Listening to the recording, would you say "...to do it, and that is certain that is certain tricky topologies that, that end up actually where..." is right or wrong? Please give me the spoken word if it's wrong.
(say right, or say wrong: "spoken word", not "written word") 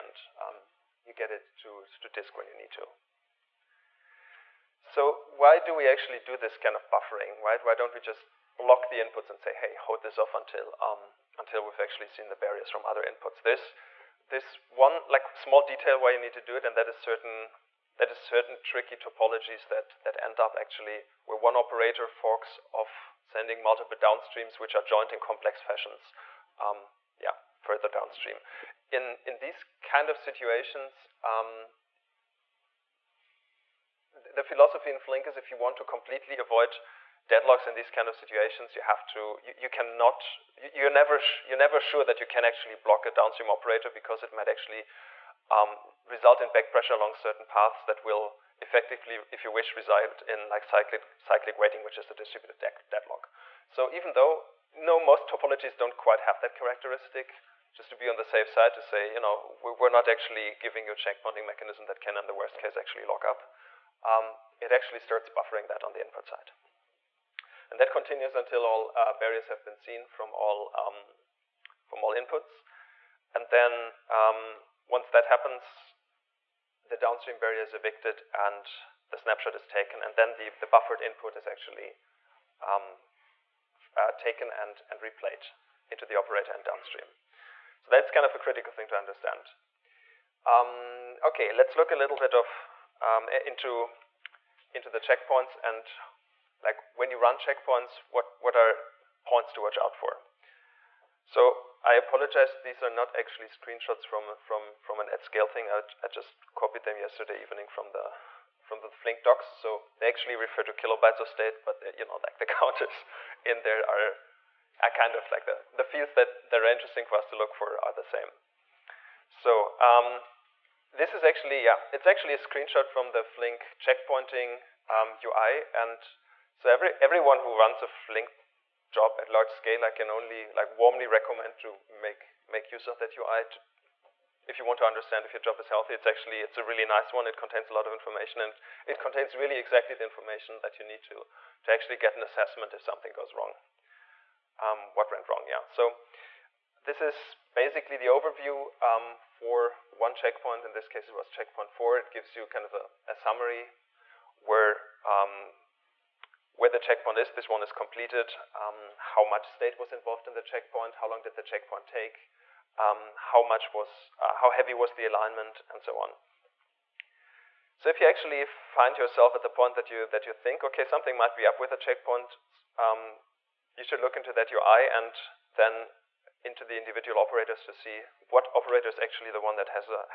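right.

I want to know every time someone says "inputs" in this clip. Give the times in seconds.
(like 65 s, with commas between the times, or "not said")
8 s, 13 s, 66 s, 72 s, 81 s.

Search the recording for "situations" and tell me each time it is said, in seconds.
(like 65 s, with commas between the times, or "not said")
30 s, 38 s.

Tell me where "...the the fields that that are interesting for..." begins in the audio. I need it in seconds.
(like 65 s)
115 s.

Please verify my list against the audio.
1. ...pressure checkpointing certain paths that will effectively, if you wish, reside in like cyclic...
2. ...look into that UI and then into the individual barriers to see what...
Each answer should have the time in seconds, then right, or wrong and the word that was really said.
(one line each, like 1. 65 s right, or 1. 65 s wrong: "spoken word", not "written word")
1. 46 s wrong: "along", not "checkpointing"
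2. 173 s wrong: "operators", not "barriers".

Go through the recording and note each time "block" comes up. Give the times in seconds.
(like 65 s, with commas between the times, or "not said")
8 s, 42 s.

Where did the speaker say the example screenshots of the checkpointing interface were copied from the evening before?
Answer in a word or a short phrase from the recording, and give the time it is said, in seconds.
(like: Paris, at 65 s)
The Flink docs, at 108 s.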